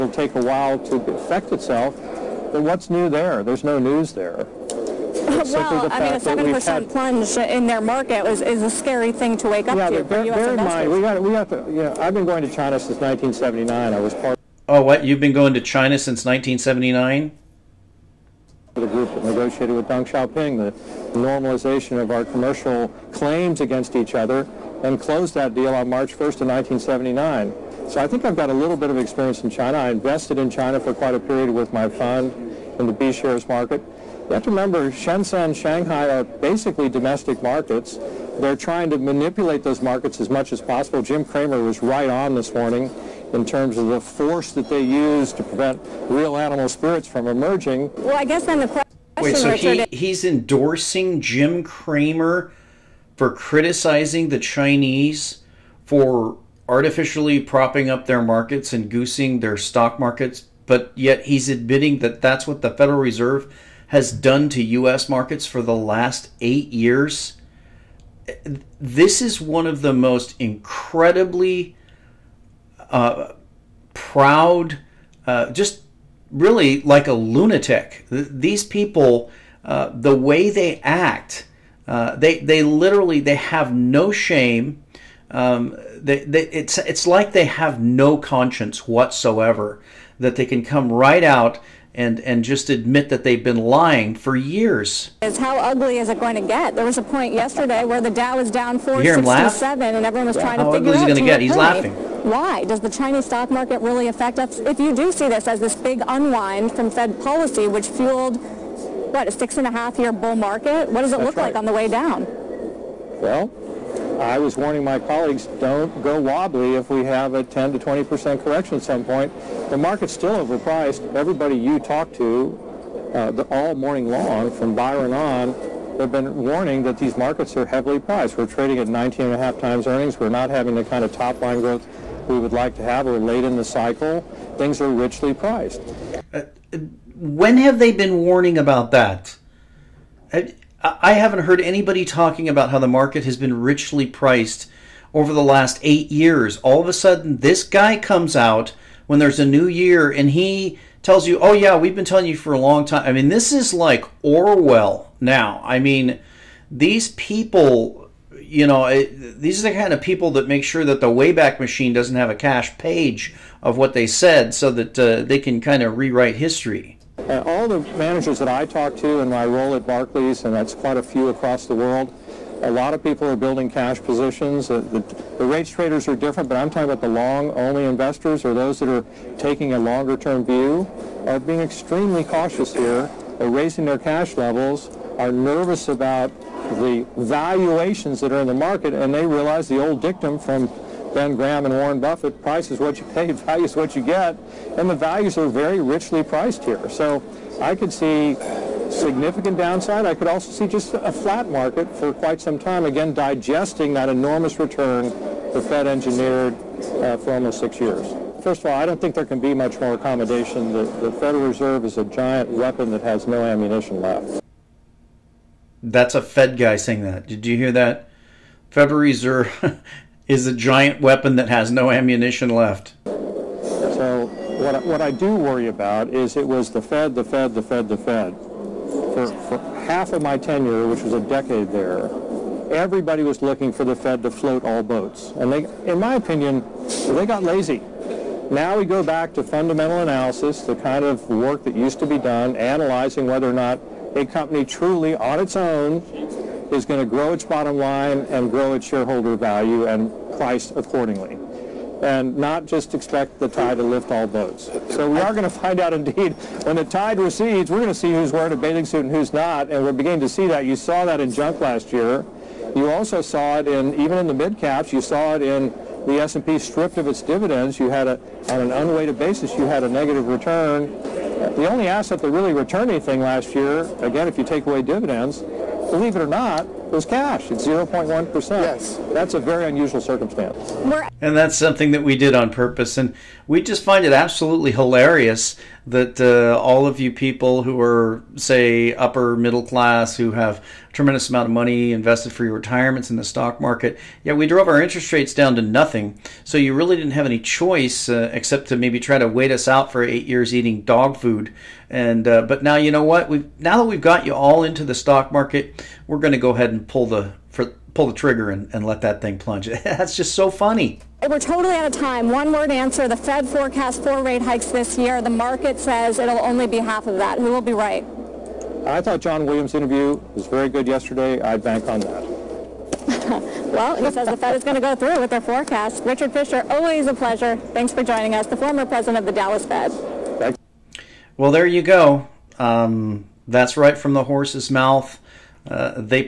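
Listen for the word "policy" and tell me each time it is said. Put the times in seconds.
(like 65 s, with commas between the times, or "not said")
107 s.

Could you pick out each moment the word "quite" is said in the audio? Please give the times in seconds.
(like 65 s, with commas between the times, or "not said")
30 s, 170 s, 202 s.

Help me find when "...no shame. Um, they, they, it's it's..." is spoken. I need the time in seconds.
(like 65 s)
83 s.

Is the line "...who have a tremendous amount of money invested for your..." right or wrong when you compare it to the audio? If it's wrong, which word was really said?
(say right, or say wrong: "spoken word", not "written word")
right.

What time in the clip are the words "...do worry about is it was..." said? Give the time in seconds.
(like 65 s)
225 s.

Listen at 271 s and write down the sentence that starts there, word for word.
The only asset that really returned anything last year, again, if you take away dividends, believe it or not, was cash.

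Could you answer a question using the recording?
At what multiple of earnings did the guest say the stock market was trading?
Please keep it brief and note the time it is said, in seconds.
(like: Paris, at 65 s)
19.5 times, at 128 s.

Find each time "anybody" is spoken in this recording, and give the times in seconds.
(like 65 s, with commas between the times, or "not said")
141 s.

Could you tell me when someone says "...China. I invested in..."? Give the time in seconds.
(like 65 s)
29 s.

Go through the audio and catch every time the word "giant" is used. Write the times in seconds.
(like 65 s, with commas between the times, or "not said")
212 s, 220 s.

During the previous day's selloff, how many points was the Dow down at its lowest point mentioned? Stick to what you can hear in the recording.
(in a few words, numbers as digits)
467.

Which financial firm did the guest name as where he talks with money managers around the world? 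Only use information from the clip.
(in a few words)
Barclays.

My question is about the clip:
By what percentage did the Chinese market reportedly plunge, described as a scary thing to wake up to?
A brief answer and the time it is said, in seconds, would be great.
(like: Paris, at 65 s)
7%, at 6 s.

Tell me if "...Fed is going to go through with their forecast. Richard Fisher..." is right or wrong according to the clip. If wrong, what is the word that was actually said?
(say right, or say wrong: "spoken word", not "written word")
right.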